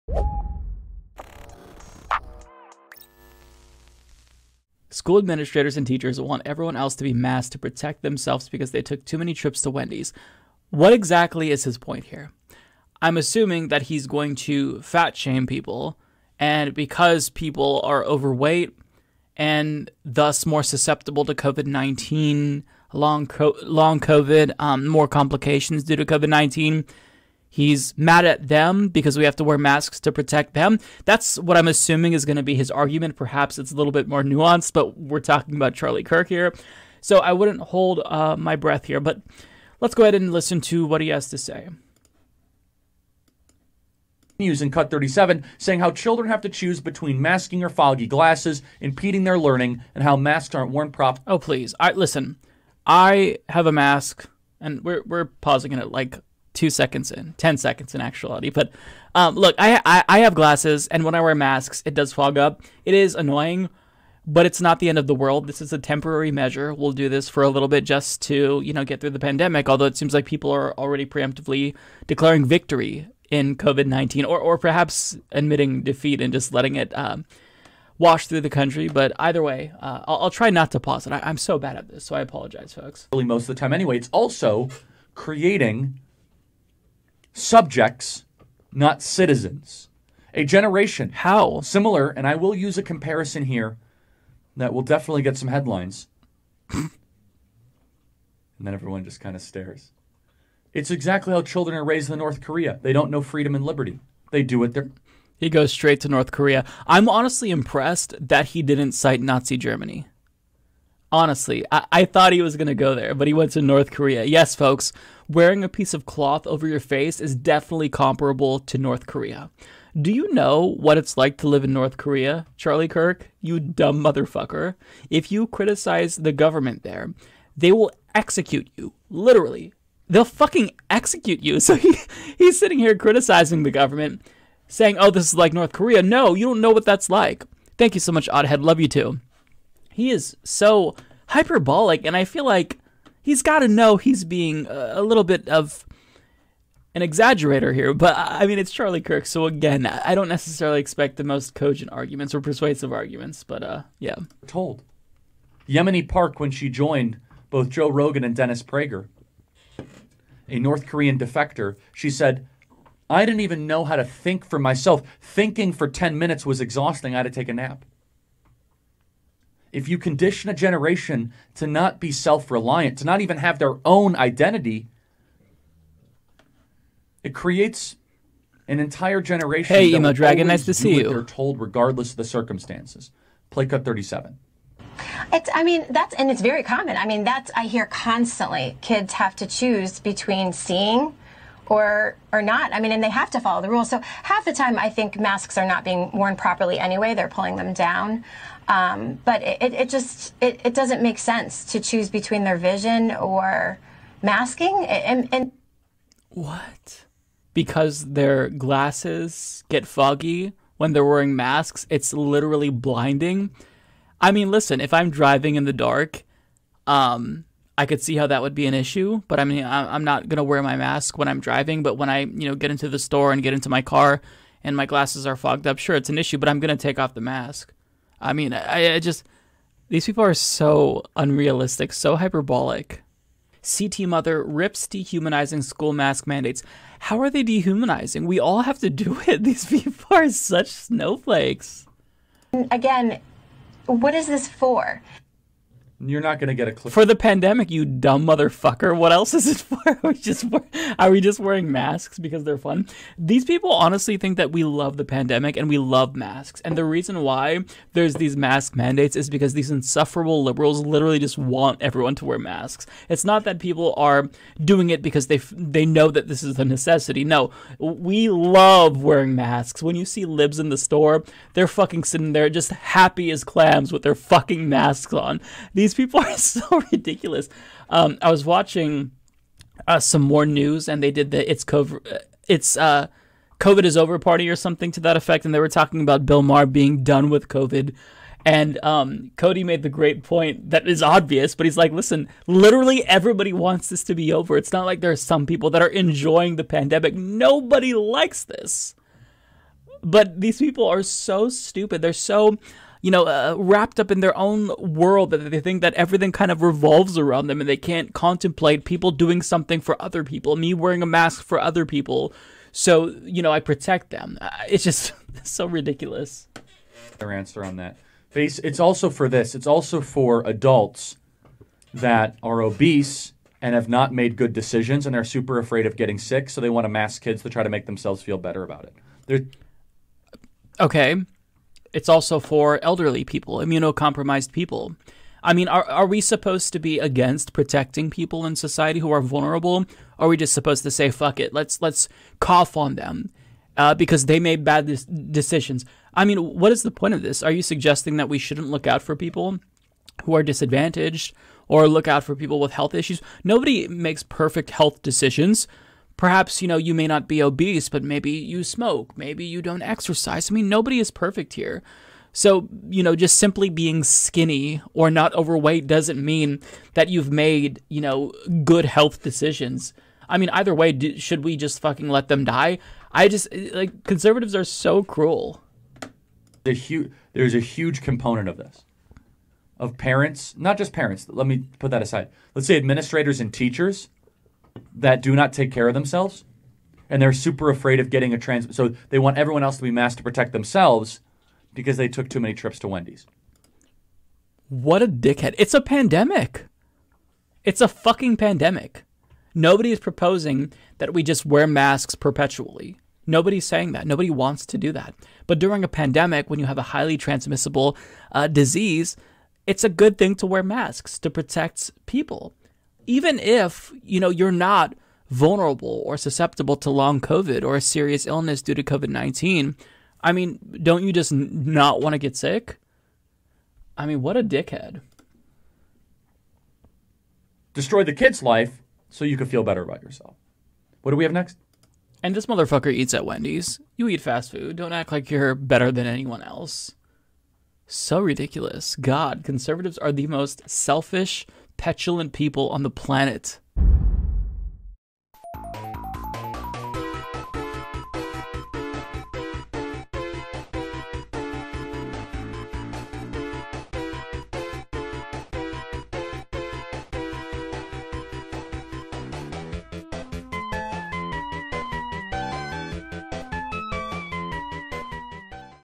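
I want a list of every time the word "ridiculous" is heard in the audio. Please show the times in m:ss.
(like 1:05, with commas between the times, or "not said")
4:36, 5:15, 7:18.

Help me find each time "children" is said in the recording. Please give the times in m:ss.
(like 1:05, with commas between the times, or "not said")
0:45, 1:41.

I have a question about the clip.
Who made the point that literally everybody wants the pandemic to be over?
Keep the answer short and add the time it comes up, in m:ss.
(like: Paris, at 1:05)
Cody, at 4:49.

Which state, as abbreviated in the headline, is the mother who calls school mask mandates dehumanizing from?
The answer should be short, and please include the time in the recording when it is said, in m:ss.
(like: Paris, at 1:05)
CT, at 3:53.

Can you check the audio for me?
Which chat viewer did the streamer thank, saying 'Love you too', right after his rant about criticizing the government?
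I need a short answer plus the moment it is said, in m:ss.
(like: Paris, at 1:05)
Oddhead, at 2:18.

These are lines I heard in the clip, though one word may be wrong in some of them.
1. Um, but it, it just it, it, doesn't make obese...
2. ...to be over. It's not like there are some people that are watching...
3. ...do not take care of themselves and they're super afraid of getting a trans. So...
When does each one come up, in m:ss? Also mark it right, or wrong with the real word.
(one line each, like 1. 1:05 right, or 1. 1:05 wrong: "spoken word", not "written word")
1. 3:18 wrong: "sense", not "obese"
2. 4:54 wrong: "enjoying", not "watching"
3. 6:25 right.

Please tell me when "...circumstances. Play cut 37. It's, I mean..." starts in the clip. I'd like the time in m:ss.
3:02.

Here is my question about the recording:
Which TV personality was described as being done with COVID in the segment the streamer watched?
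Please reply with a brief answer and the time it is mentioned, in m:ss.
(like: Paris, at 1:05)
Bill Maher, at 4:46.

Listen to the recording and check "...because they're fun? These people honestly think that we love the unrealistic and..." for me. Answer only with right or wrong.
wrong.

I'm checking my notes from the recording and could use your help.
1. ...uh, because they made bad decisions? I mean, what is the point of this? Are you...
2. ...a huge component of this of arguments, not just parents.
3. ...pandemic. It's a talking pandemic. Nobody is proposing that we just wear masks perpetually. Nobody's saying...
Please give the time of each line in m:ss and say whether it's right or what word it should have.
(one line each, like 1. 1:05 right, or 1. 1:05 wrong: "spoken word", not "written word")
1. 5:43 right
2. 6:17 wrong: "parents", not "arguments"
3. 6:35 wrong: "fucking", not "talking".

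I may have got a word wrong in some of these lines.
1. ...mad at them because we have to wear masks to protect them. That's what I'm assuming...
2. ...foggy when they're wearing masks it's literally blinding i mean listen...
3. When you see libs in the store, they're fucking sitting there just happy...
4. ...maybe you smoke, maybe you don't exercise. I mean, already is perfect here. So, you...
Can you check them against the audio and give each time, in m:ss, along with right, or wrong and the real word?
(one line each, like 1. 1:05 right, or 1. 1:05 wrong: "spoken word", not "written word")
1. 0:27 right
2. 3:29 right
3. 4:29 right
4. 5:58 wrong: "nobody", not "already".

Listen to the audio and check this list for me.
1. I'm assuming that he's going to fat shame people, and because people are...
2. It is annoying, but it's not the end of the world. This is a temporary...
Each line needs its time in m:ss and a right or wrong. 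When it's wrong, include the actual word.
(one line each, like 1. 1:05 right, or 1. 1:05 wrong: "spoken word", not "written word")
1. 0:13 right
2. 1:02 right.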